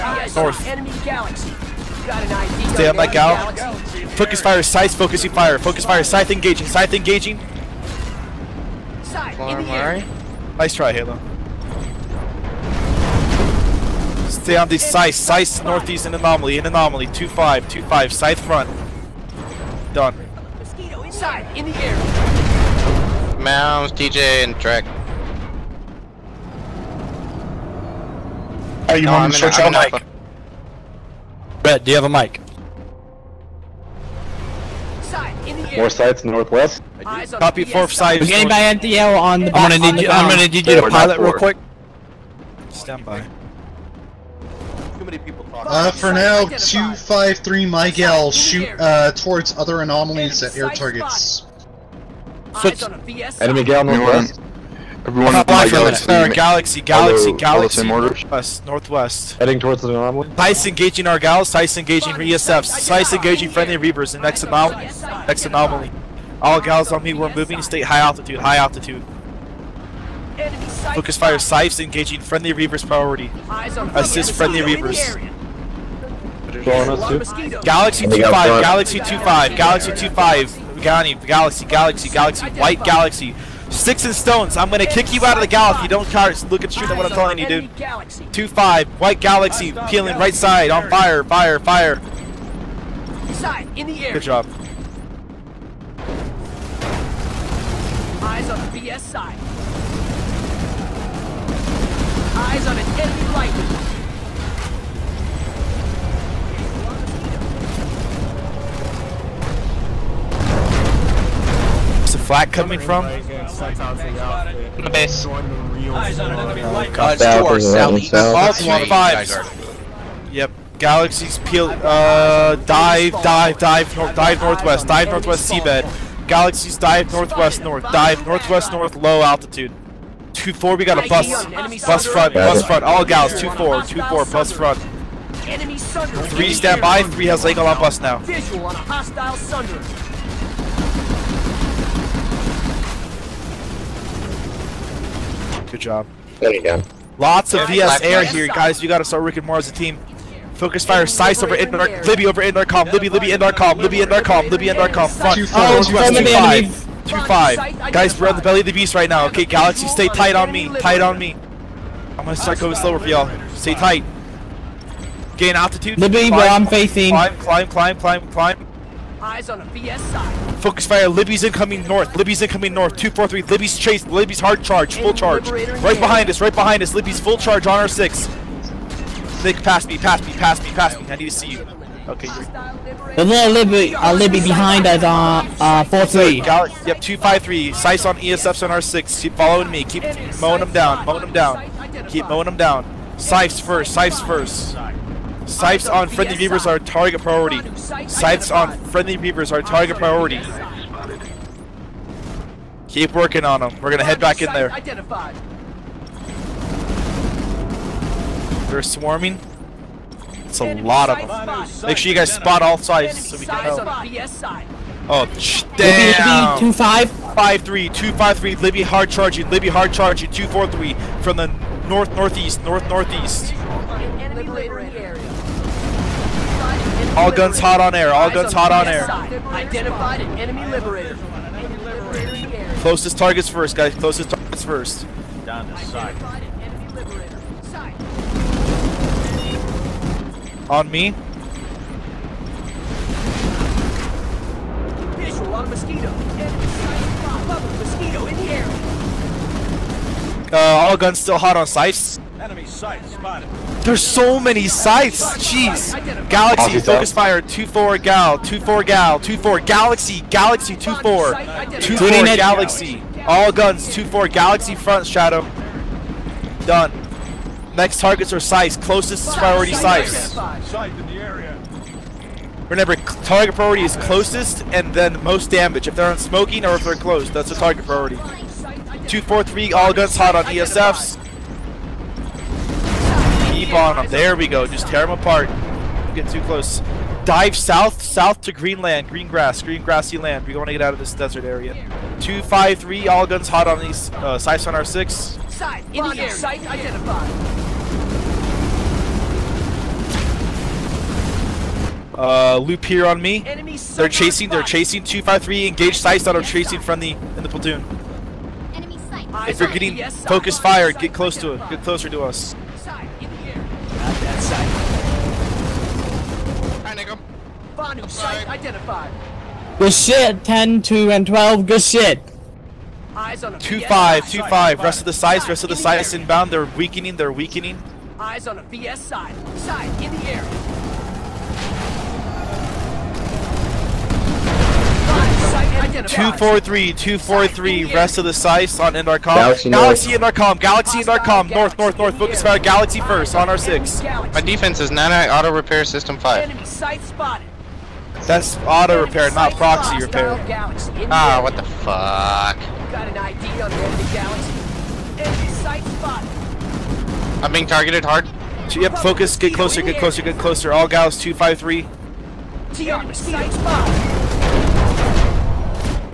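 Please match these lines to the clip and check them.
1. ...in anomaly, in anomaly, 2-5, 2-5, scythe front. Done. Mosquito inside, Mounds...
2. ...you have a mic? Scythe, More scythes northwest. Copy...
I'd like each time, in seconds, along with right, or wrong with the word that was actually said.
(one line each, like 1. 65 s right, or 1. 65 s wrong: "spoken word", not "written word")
1. 16 s right
2. 31 s right.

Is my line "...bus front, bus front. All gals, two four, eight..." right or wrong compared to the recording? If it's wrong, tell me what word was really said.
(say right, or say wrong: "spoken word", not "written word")
wrong: "two", not "eight".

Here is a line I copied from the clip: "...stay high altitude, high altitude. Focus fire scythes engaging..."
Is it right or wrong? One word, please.
right.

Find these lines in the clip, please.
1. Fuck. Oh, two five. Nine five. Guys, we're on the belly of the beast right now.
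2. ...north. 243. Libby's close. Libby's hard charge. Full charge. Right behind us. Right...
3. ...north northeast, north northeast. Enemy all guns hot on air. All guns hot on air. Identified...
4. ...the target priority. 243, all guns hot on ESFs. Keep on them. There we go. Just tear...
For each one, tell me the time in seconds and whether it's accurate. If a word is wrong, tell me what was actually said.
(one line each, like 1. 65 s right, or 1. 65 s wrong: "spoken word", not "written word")
1. 155 s wrong: "Two", not "Nine"
2. 172 s wrong: "chase", not "close"
3. 221 s right
4. 277 s right.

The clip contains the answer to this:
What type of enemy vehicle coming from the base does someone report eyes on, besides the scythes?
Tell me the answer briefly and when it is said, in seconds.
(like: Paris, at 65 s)
Lightning, at 102 s.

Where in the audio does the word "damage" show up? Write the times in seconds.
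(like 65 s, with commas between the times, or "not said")
275 s.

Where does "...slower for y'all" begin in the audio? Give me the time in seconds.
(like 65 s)
162 s.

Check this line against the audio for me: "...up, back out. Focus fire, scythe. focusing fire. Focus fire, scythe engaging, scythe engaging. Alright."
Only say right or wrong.
right.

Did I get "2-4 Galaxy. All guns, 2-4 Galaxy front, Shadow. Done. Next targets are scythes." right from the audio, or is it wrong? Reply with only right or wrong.
right.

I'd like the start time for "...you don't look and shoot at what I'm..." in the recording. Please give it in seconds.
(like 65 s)
85 s.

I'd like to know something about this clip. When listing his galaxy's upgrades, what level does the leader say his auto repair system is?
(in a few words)
5.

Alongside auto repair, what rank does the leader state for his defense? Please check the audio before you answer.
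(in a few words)
9.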